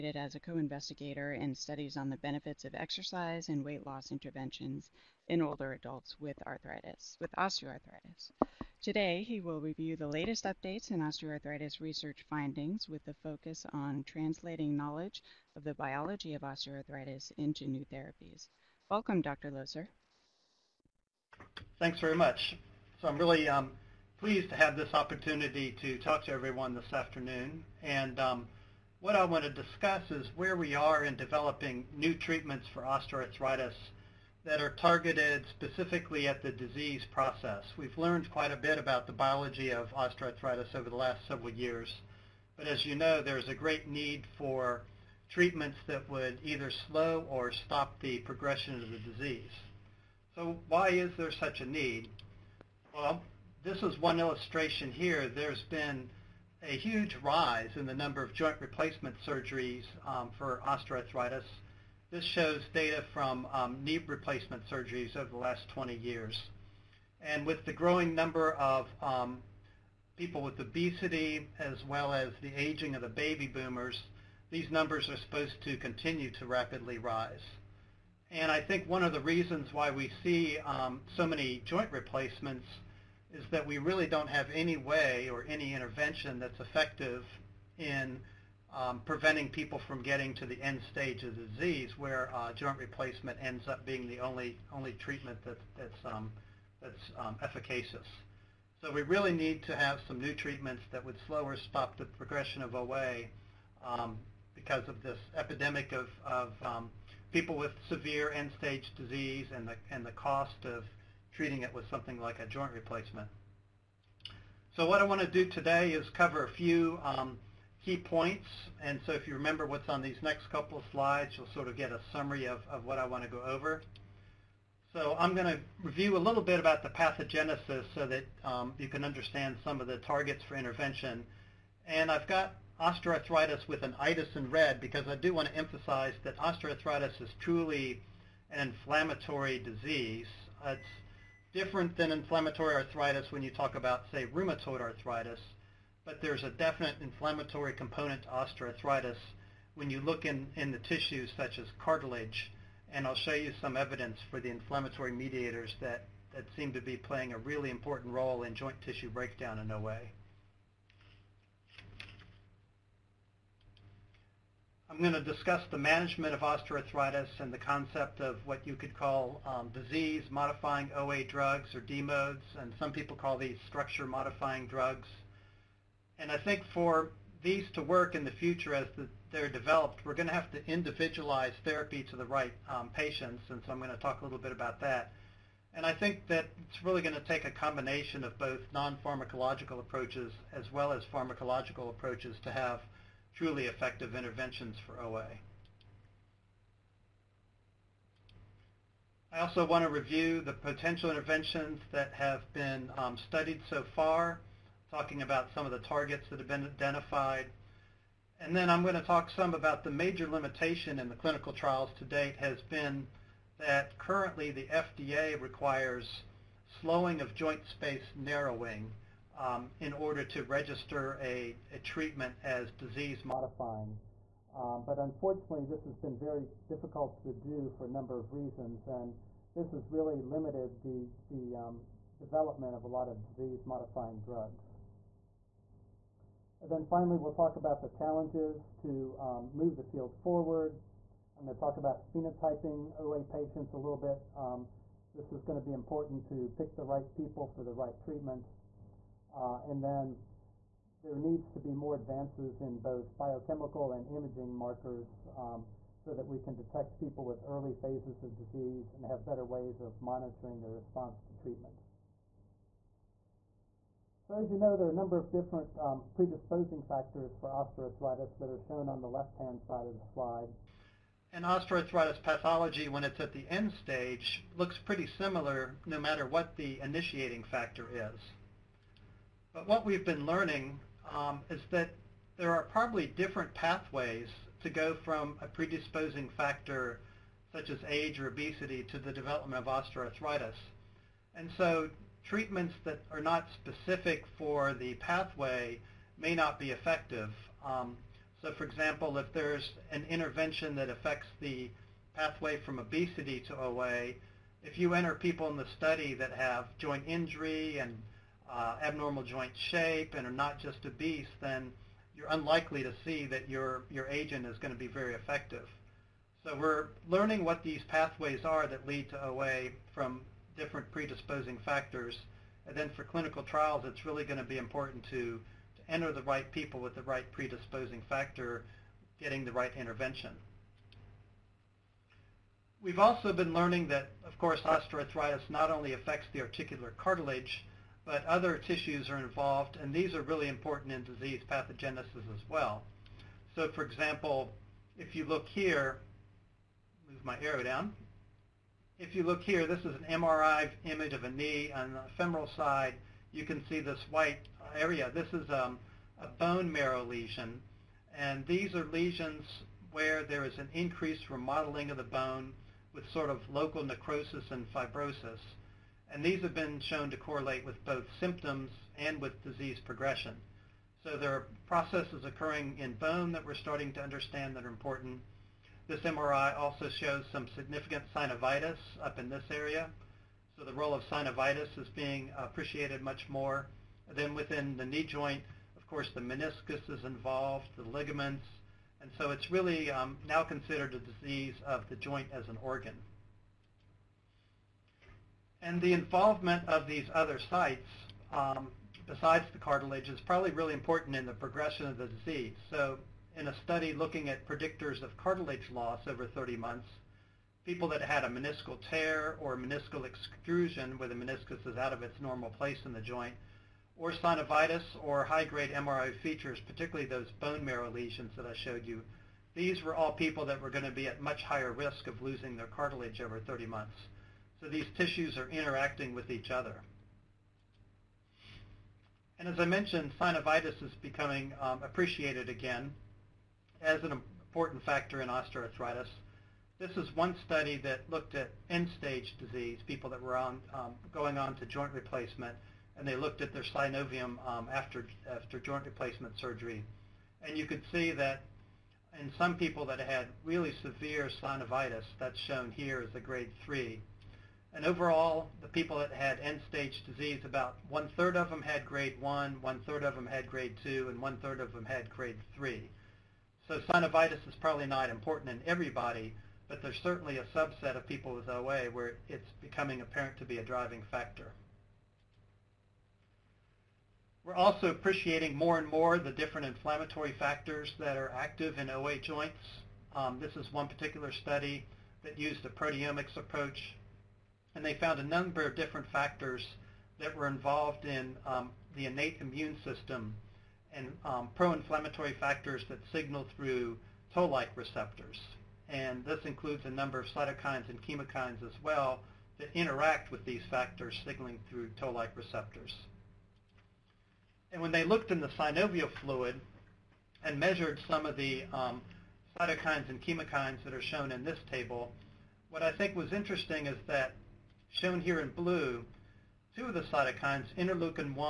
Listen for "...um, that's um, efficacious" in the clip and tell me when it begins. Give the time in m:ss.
1:36.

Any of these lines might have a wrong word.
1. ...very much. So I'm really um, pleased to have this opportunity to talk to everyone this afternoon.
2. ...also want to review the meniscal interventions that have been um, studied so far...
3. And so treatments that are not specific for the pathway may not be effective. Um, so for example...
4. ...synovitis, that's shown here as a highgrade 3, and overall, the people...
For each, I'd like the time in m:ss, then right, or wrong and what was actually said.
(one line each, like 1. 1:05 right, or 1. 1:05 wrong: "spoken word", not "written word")
1. 0:21 right
2. 3:19 wrong: "potential", not "meniscal"
3. 4:51 right
4. 7:31 wrong: "grade", not "highgrade".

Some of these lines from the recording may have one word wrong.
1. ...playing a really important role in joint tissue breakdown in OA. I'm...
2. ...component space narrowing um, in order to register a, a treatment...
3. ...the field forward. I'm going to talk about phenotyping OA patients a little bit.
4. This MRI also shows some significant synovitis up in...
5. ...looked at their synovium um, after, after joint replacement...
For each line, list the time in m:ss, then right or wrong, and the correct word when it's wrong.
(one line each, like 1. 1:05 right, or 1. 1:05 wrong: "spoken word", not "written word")
1. 2:36 right
2. 3:37 wrong: "joint", not "component"
3. 3:59 right
4. 6:15 right
5. 7:23 right.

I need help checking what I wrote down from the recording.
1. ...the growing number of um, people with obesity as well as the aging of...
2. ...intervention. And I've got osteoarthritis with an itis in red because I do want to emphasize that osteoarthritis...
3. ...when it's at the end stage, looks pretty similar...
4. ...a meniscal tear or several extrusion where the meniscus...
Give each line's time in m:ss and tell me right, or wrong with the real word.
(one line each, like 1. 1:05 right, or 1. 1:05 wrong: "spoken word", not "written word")
1. 1:07 right
2. 2:10 right
3. 4:32 right
4. 6:48 wrong: "meniscal", not "several".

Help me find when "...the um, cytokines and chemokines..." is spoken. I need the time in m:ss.
8:28.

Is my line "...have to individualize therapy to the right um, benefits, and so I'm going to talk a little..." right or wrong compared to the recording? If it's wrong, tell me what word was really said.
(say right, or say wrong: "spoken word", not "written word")
wrong: "patients", not "benefits".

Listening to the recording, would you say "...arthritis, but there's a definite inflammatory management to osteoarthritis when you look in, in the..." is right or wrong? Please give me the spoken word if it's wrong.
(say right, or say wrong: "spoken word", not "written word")
wrong: "component", not "management".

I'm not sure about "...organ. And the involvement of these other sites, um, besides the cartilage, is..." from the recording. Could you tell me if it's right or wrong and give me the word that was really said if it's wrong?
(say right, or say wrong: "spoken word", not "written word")
right.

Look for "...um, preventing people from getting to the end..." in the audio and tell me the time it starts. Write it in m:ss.
1:28.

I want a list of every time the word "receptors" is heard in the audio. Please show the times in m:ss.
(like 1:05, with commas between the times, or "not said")
8:14, 8:22.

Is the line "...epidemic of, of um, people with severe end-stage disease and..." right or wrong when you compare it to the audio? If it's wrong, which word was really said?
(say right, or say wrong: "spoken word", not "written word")
right.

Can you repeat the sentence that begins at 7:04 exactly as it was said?
So these tissues are interacting with each other.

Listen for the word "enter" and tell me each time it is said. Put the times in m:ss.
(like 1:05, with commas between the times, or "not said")
5:04, 5:25.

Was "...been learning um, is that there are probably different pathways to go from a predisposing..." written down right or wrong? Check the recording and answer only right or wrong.
right.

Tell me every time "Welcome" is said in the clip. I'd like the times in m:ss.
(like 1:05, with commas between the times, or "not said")
0:18.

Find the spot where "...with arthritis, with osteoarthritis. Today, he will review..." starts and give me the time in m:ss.
0:06.